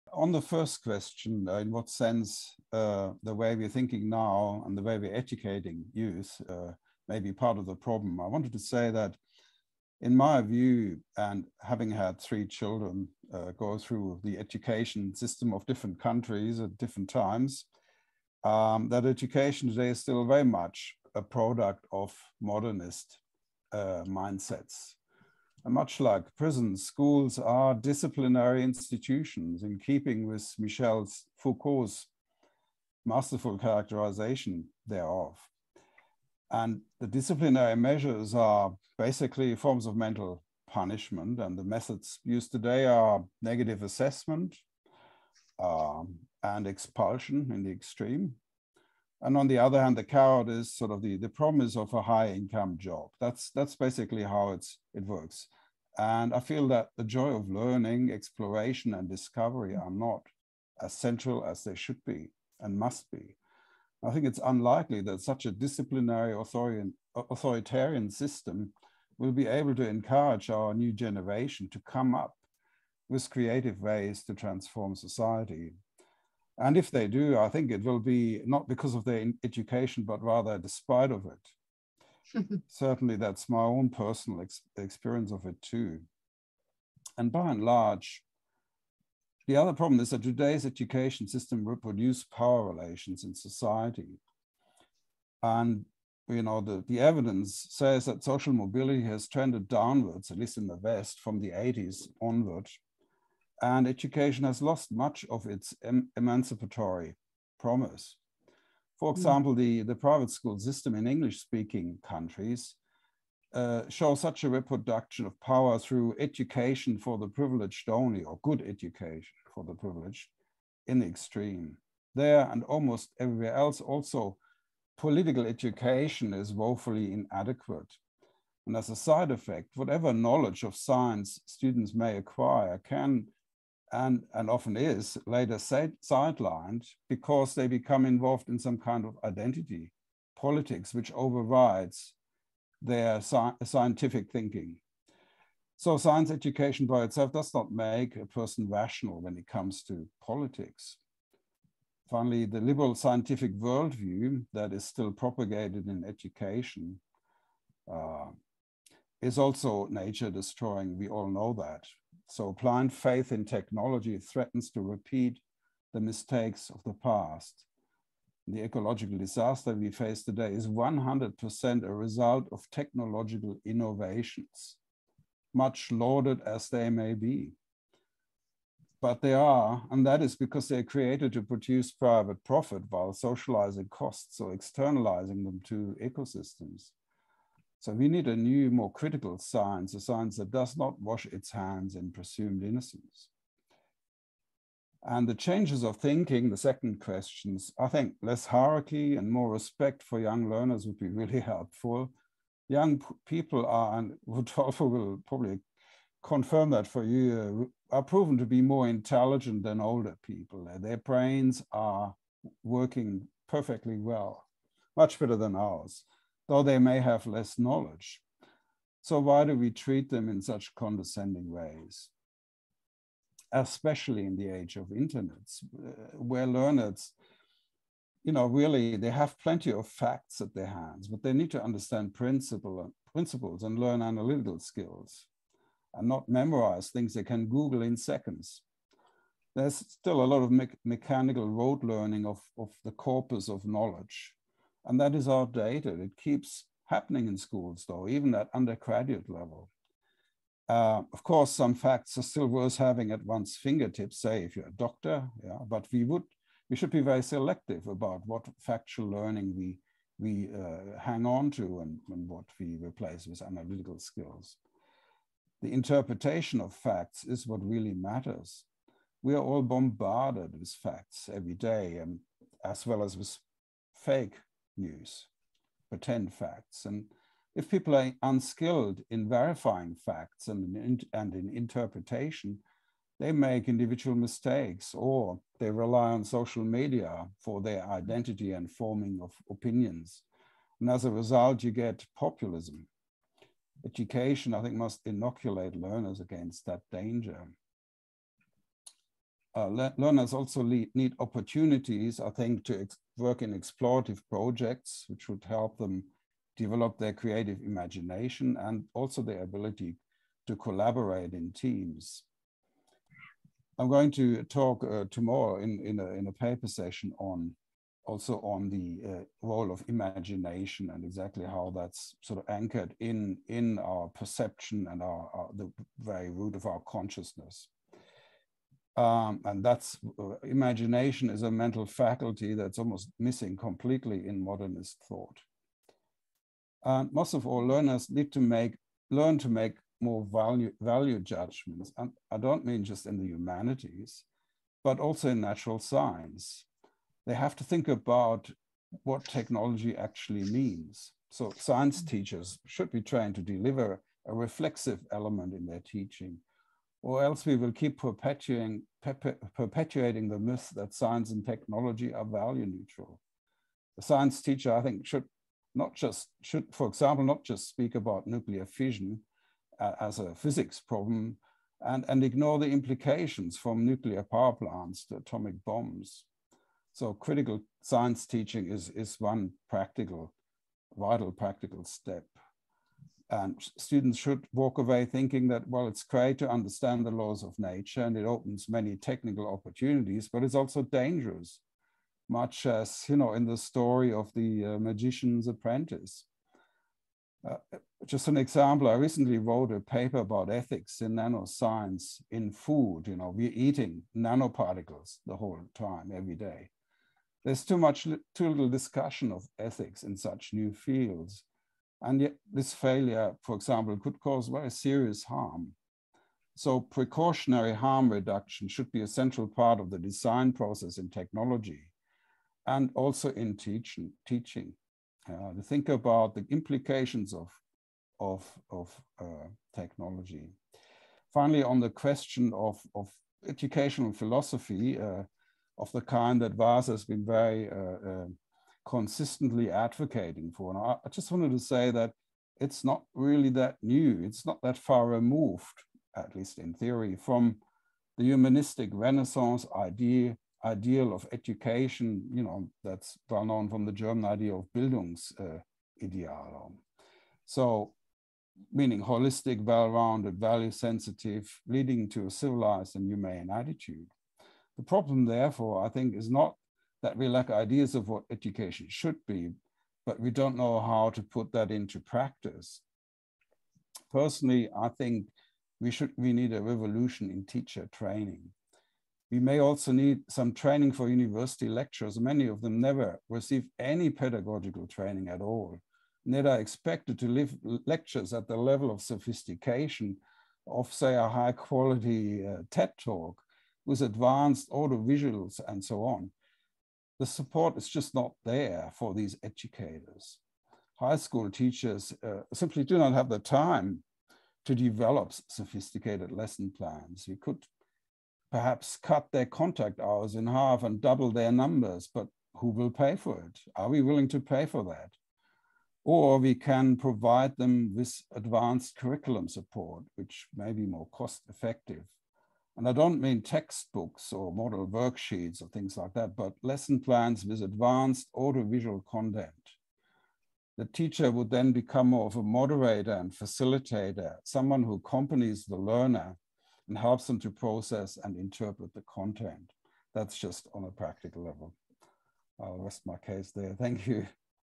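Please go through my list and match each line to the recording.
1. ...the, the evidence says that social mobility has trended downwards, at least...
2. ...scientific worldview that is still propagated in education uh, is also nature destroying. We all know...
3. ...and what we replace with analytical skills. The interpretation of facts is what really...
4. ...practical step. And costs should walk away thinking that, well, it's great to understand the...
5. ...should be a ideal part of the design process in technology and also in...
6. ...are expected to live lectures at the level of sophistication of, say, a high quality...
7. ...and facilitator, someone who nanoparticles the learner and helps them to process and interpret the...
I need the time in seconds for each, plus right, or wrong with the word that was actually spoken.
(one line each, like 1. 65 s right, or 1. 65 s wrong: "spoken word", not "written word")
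1. 96 s right
2. 152 s right
3. 262 s right
4. 381 s wrong: "students", not "costs"
5. 418 s wrong: "central", not "ideal"
6. 486 s right
7. 533 s wrong: "accompanies", not "nanoparticles".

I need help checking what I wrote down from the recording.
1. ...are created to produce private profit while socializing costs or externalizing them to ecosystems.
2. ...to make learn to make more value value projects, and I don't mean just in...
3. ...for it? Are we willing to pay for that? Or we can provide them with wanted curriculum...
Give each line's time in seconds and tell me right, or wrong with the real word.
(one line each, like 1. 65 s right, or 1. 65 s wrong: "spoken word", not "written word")
1. 180 s right
2. 338 s wrong: "judgments", not "projects"
3. 513 s wrong: "advanced", not "wanted".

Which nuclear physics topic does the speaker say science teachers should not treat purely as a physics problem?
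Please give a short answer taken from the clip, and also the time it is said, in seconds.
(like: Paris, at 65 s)
Nuclear fission, at 368 s.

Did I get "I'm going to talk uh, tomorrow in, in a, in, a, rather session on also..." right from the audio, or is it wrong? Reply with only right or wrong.
wrong.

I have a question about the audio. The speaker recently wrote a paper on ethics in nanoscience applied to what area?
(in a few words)
Food.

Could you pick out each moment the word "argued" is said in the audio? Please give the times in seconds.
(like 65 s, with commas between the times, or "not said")
not said.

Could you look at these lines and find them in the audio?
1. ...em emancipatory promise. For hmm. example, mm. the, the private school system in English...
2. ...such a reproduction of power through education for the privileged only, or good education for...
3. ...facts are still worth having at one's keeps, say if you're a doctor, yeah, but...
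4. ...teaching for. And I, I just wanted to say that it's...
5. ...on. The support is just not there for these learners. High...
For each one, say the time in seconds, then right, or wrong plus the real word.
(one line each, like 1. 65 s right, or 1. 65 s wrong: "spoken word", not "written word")
1. 105 s right
2. 114 s right
3. 251 s wrong: "fingertips", not "keeps"
4. 439 s wrong: "advocating", not "teaching"
5. 496 s wrong: "educators", not "learners".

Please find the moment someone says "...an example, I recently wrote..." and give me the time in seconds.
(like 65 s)
398 s.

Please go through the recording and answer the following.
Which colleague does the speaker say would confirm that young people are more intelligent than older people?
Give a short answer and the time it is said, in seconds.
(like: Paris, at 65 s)
Rodolfo, at 204 s.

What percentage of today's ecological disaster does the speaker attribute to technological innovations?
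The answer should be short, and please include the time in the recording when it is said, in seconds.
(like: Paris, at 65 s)
100%, at 170 s.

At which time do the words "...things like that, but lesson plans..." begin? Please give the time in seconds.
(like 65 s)
525 s.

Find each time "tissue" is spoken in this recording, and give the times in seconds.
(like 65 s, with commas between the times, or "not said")
not said.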